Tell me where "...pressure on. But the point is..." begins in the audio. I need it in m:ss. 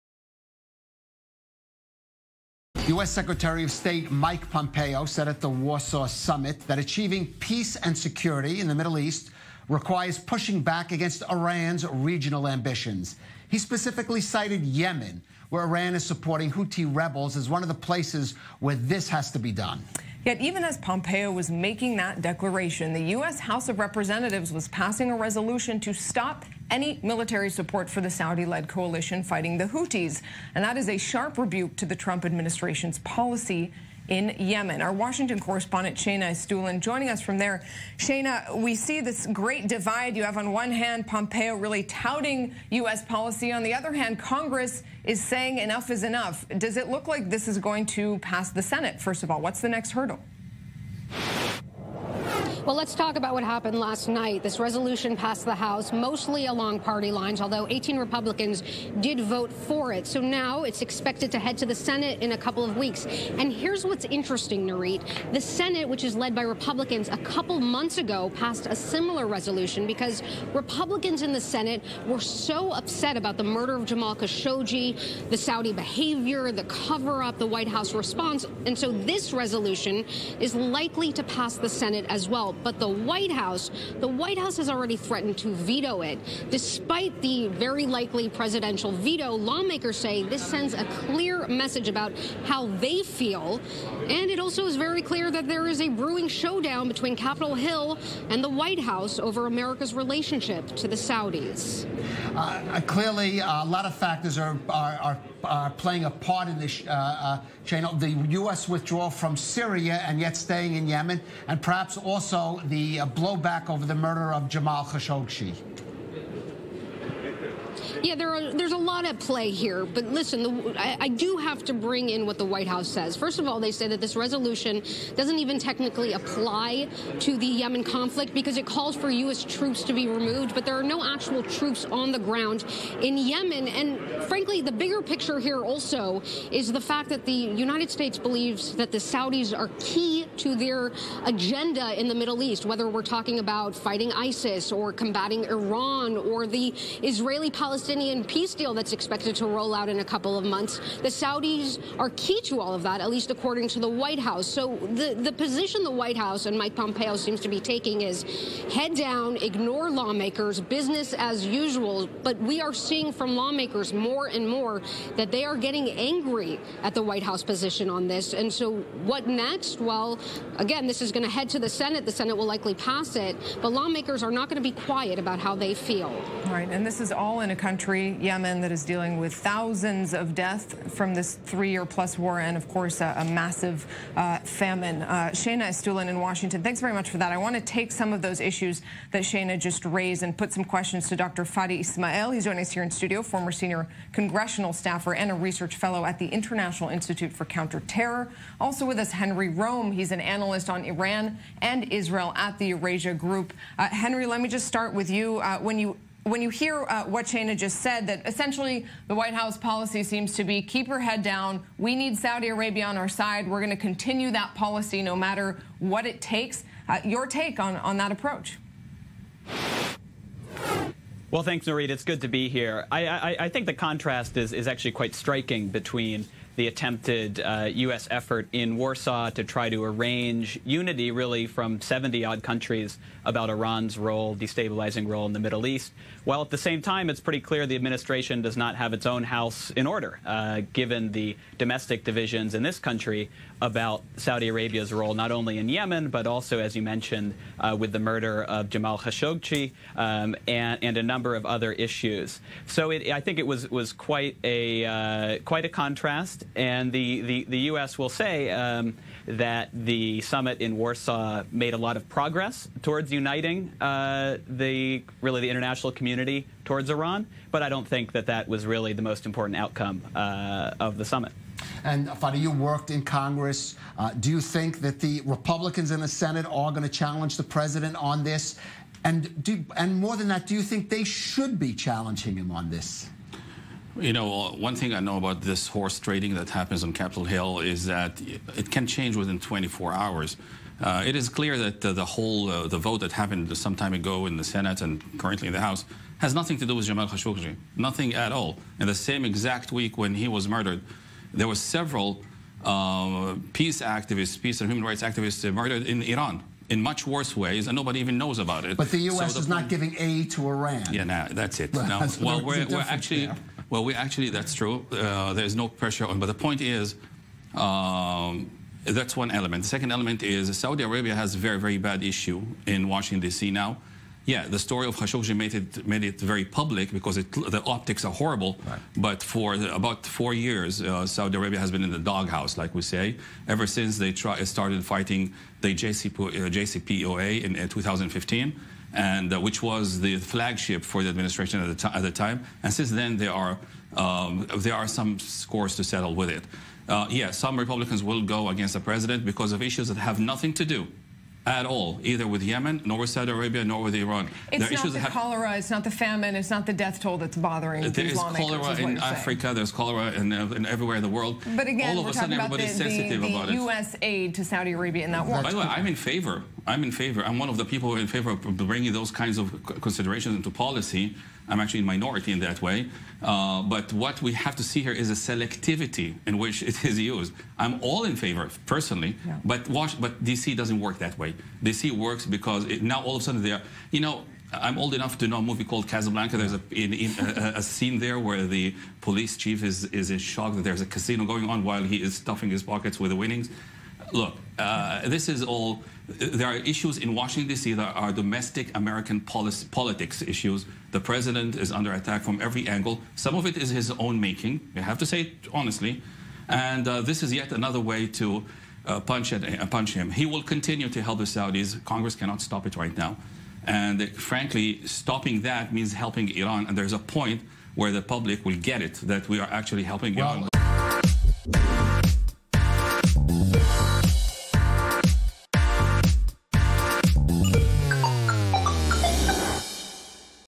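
5:15.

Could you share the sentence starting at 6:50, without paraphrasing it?
He will continue to help the Saudis.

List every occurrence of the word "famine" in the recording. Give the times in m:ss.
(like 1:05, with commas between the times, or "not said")
3:04, 5:55.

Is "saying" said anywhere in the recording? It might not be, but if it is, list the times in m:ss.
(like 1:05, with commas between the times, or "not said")
0:45, 5:59.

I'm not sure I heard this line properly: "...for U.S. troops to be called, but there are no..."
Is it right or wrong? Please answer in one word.
wrong.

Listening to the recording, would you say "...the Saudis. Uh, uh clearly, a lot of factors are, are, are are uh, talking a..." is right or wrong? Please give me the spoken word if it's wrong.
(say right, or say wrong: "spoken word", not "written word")
wrong: "playing", not "talking".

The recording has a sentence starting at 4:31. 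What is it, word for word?
And Fadi, you worked in Congress.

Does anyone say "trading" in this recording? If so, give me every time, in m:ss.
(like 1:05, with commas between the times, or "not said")
4:45.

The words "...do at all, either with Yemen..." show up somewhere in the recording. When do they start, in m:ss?
5:50.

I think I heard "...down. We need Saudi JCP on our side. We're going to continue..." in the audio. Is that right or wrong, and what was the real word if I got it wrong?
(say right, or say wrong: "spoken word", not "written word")
wrong: "Arabia", not "JCP".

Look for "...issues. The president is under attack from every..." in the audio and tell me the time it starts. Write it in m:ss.
6:40.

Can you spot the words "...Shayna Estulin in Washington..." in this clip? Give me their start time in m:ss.
3:05.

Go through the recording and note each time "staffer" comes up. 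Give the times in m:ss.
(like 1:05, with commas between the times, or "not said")
3:14.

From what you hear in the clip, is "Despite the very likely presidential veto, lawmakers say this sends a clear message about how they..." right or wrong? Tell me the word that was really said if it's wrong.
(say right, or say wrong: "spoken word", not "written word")
right.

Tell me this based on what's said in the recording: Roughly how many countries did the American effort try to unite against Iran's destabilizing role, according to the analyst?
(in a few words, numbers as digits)
70.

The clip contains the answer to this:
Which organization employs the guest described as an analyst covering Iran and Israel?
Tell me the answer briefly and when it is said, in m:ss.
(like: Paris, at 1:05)
Eurasia Group, at 3:22.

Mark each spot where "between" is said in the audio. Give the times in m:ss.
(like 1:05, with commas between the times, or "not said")
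1:36, 3:45.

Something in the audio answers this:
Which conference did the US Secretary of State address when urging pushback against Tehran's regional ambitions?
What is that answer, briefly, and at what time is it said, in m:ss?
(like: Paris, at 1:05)
Warsaw Summit, at 0:05.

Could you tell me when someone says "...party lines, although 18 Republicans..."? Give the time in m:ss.
0:56.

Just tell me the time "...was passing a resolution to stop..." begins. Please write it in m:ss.
0:24.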